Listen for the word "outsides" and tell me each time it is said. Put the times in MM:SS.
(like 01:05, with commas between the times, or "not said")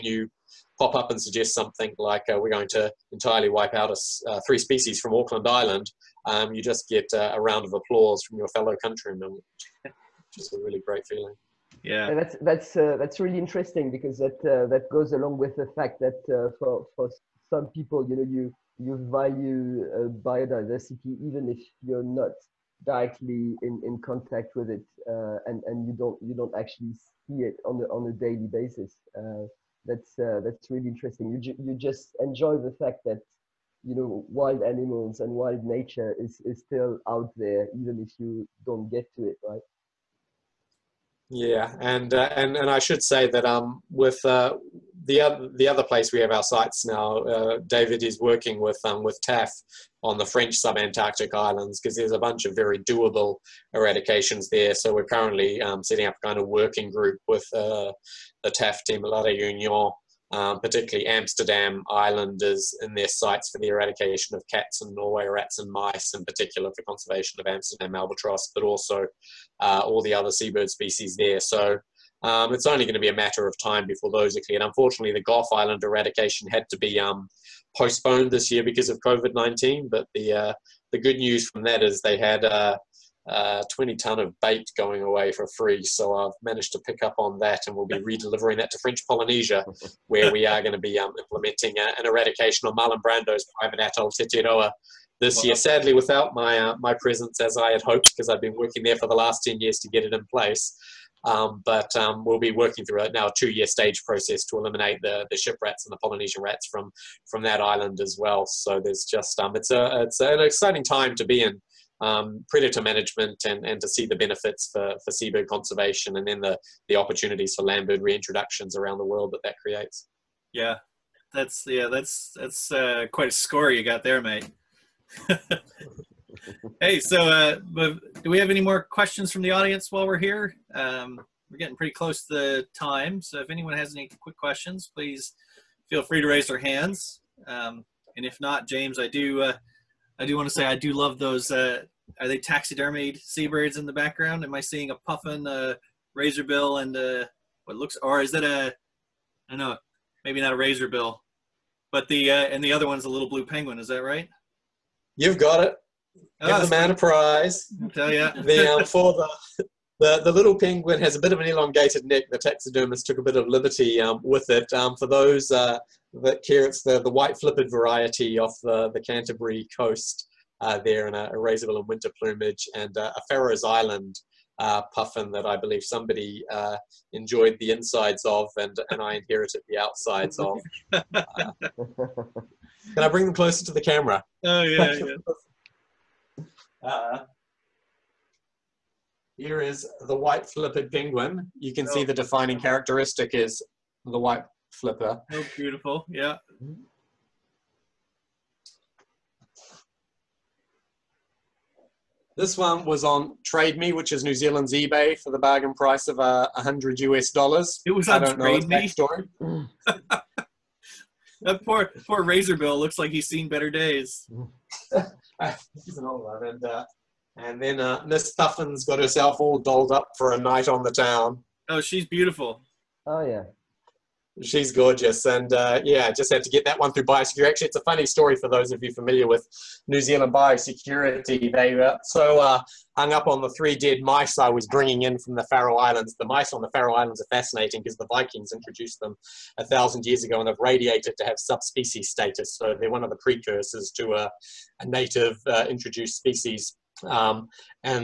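02:59.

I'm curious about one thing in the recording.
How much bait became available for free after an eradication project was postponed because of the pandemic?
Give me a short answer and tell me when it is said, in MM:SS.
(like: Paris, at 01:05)
20 tons, at 01:23.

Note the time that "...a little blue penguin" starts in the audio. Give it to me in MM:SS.
02:33.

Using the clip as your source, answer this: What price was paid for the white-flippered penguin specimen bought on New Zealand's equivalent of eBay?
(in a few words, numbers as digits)
100 US dollars.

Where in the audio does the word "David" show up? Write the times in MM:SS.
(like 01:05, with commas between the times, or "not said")
00:47.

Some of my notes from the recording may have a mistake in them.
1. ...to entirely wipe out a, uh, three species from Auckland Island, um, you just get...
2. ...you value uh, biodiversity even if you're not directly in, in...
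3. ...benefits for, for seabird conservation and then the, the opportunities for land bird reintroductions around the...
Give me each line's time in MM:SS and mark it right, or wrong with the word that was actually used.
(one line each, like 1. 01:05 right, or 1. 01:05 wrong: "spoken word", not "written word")
1. 00:02 right
2. 00:18 right
3. 01:54 right.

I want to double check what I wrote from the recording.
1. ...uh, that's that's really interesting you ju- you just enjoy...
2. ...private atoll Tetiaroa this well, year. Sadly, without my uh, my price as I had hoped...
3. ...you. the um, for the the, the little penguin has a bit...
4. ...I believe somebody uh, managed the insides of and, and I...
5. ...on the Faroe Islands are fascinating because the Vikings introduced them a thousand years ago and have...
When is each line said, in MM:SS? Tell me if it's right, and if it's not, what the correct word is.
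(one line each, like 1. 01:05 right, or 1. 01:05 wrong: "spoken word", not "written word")
1. 00:29 right
2. 01:33 wrong: "presence", not "price"
3. 02:38 right
4. 02:55 wrong: "enjoyed", not "managed"
5. 03:56 right.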